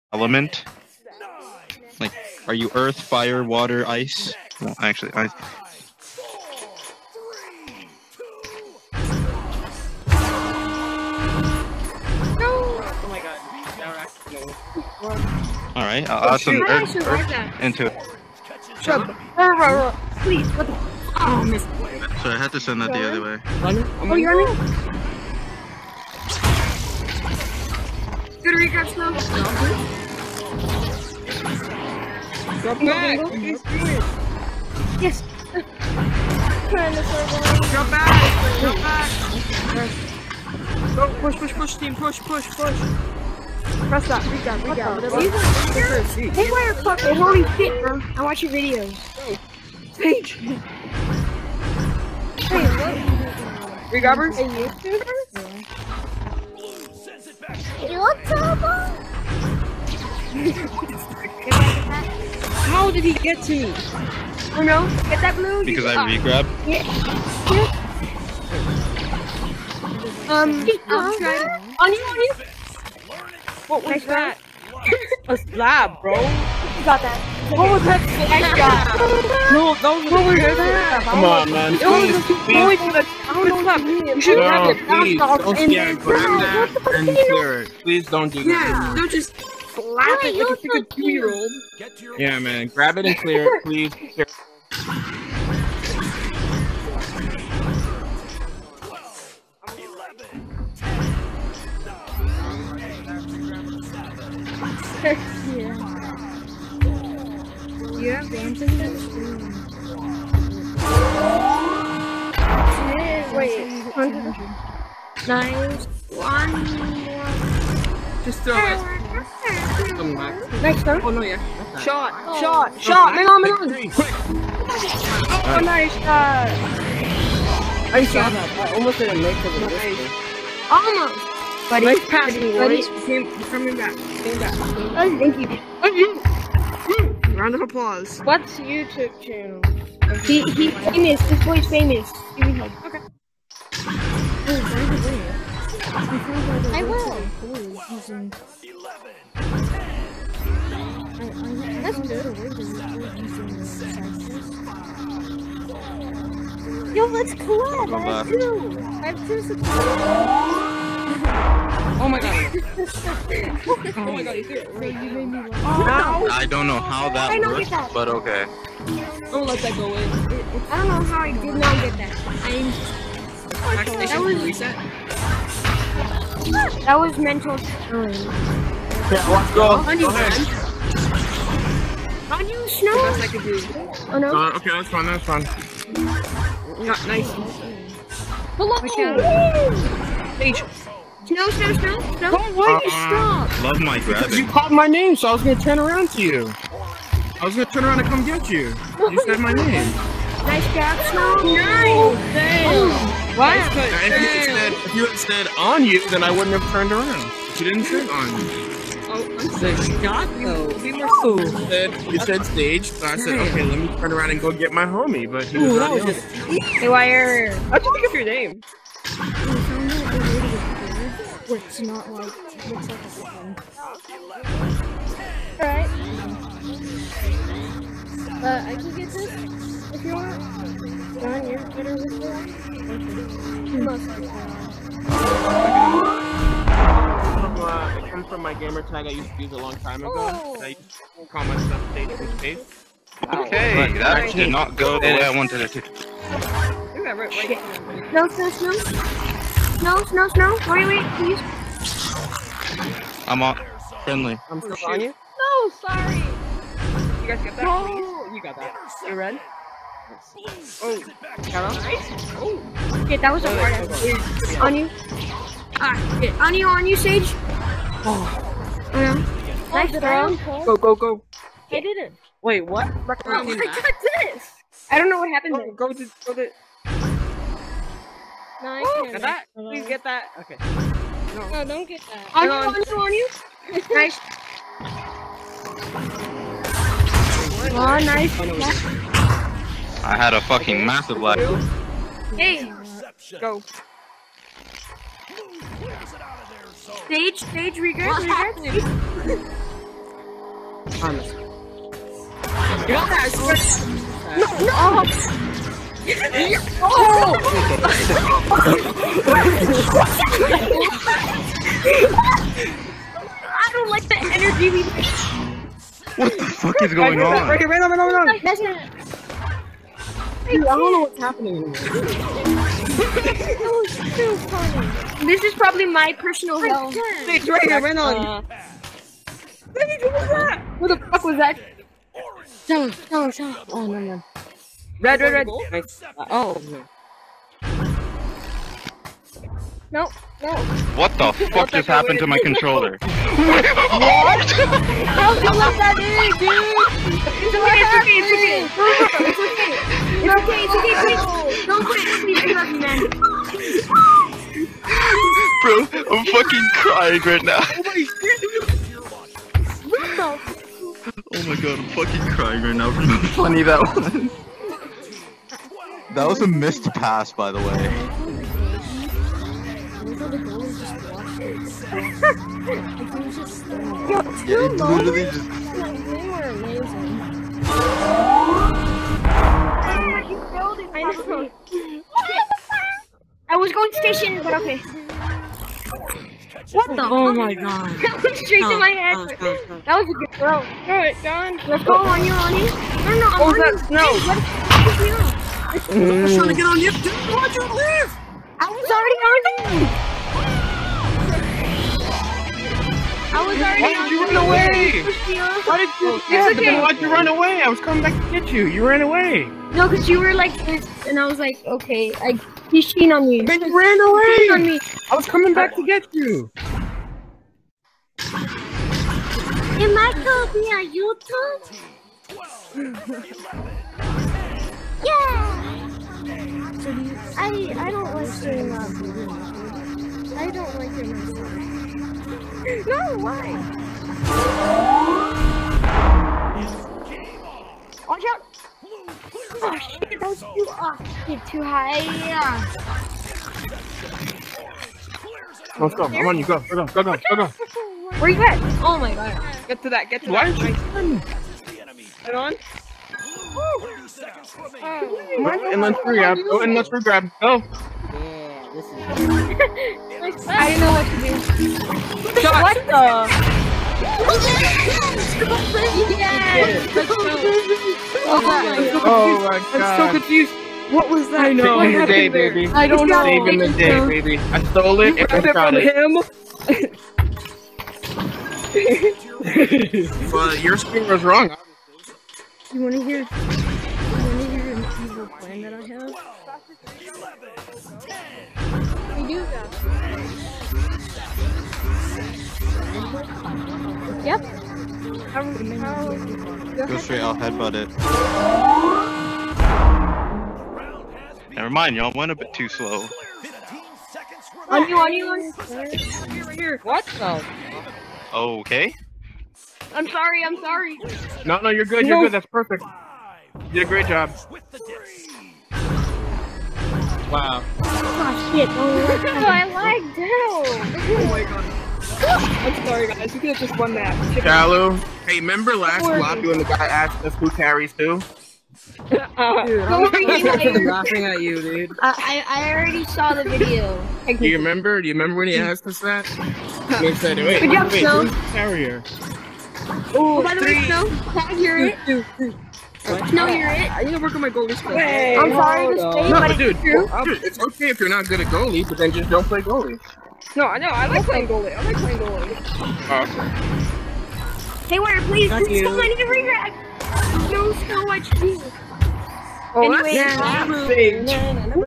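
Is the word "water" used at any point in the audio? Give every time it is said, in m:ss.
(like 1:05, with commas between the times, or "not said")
0:03.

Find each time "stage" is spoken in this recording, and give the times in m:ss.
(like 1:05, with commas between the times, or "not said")
3:32, 4:01, 4:57.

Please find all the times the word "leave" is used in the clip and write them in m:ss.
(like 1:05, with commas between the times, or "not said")
6:37.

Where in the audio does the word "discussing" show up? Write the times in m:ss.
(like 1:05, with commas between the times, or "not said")
not said.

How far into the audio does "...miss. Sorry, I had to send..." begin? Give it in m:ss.
0:21.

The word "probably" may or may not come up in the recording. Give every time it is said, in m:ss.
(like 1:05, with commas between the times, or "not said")
5:25.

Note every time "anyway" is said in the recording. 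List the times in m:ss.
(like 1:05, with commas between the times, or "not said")
9:19.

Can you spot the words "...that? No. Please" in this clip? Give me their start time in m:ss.
4:17.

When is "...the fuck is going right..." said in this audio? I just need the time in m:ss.
5:16.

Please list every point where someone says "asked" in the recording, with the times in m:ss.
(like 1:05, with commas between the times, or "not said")
8:46, 8:55.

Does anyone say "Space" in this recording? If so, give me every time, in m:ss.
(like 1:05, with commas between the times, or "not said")
4:02.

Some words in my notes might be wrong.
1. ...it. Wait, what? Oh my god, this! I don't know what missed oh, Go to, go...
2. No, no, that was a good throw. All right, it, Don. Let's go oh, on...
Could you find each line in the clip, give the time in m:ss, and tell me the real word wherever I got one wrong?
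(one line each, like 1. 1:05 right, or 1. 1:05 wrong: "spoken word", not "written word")
1. 4:31 wrong: "happened", not "missed"
2. 6:29 right.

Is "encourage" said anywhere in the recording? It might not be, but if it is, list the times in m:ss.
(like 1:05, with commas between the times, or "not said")
not said.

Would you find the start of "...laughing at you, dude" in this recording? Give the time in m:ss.
8:50.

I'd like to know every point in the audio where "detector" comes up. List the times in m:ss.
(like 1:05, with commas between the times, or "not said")
not said.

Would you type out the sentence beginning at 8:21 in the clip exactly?
Never mind, y'all went a bit too slow.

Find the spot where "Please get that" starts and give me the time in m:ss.
4:39.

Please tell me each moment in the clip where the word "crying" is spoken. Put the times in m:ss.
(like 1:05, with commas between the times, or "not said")
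5:56, 6:02.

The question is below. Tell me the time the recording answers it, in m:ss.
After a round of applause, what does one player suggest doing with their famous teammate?
2:36.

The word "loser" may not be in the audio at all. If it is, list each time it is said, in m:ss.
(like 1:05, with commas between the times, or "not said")
not said.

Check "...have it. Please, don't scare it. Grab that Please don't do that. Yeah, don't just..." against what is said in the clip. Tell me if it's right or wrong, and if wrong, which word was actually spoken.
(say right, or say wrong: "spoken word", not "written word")
right.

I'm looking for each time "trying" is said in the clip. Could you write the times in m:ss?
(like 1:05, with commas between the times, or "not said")
6:36.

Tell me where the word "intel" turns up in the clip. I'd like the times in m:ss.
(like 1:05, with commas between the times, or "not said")
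not said.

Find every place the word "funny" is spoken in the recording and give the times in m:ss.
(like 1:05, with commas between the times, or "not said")
5:24, 6:03.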